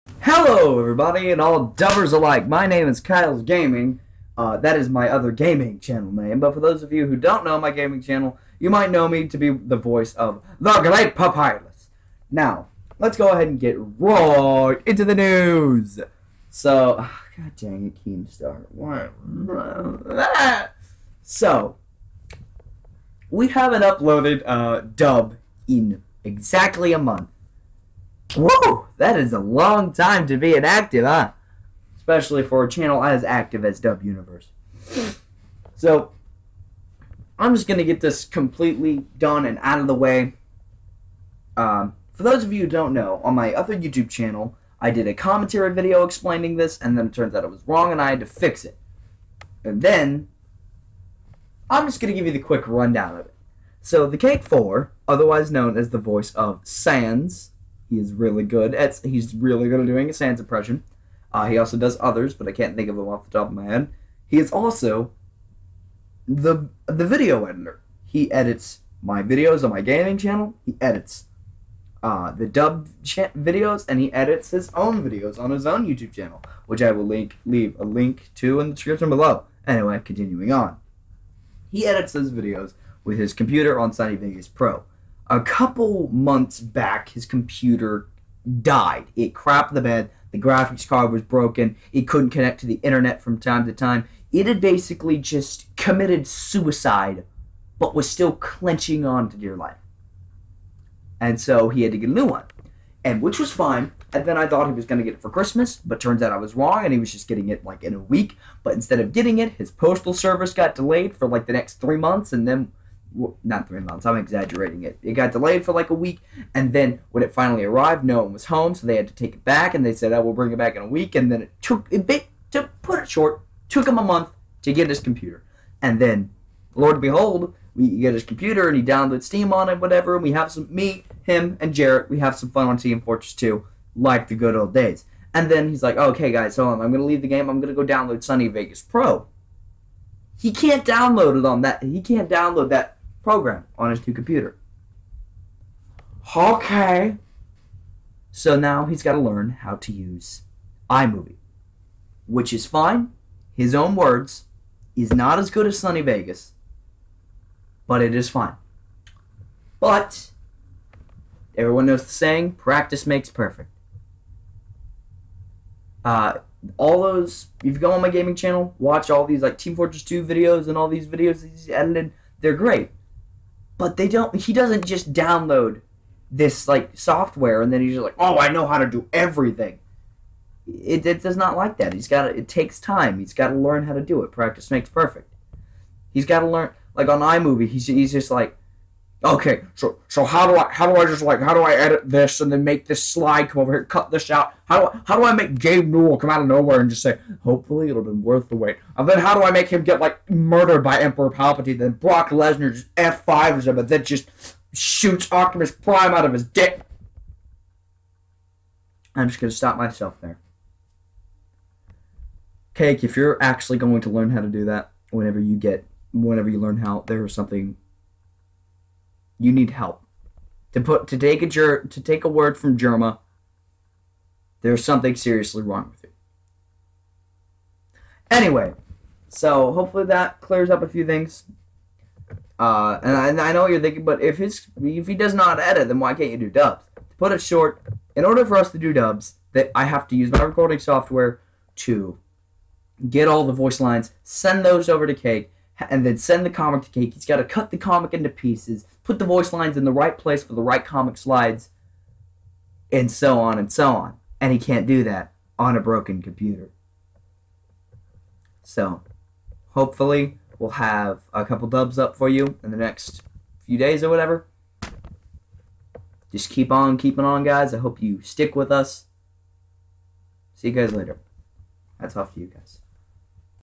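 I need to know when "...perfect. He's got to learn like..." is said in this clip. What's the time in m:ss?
3:04.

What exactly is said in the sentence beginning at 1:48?
But instead of getting it, his postal service got delayed for like the next three months, and then not three months.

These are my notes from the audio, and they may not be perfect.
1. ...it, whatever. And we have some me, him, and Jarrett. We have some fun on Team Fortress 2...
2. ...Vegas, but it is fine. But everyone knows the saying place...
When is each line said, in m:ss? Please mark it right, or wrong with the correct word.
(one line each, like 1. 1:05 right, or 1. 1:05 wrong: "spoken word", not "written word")
1. 2:09 right
2. 2:36 wrong: "practice", not "place".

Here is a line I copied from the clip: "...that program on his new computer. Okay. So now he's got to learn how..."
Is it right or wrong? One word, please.
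right.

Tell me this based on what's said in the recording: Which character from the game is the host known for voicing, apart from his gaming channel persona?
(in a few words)
Papyrus.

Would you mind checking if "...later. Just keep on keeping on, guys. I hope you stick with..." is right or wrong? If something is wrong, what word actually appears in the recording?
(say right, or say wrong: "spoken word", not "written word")
wrong: "whatever", not "later".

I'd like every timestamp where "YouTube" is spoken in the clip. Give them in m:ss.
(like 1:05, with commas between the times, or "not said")
0:43, 1:15.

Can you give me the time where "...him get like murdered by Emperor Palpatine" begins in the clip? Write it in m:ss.
3:19.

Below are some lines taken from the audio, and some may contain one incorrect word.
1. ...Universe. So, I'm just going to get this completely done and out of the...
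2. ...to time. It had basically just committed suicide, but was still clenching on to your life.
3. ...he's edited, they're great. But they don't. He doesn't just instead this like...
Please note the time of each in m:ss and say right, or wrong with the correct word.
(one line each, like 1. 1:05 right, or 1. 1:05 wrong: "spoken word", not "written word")
1. 0:34 right
2. 1:33 right
3. 2:51 wrong: "download", not "instead".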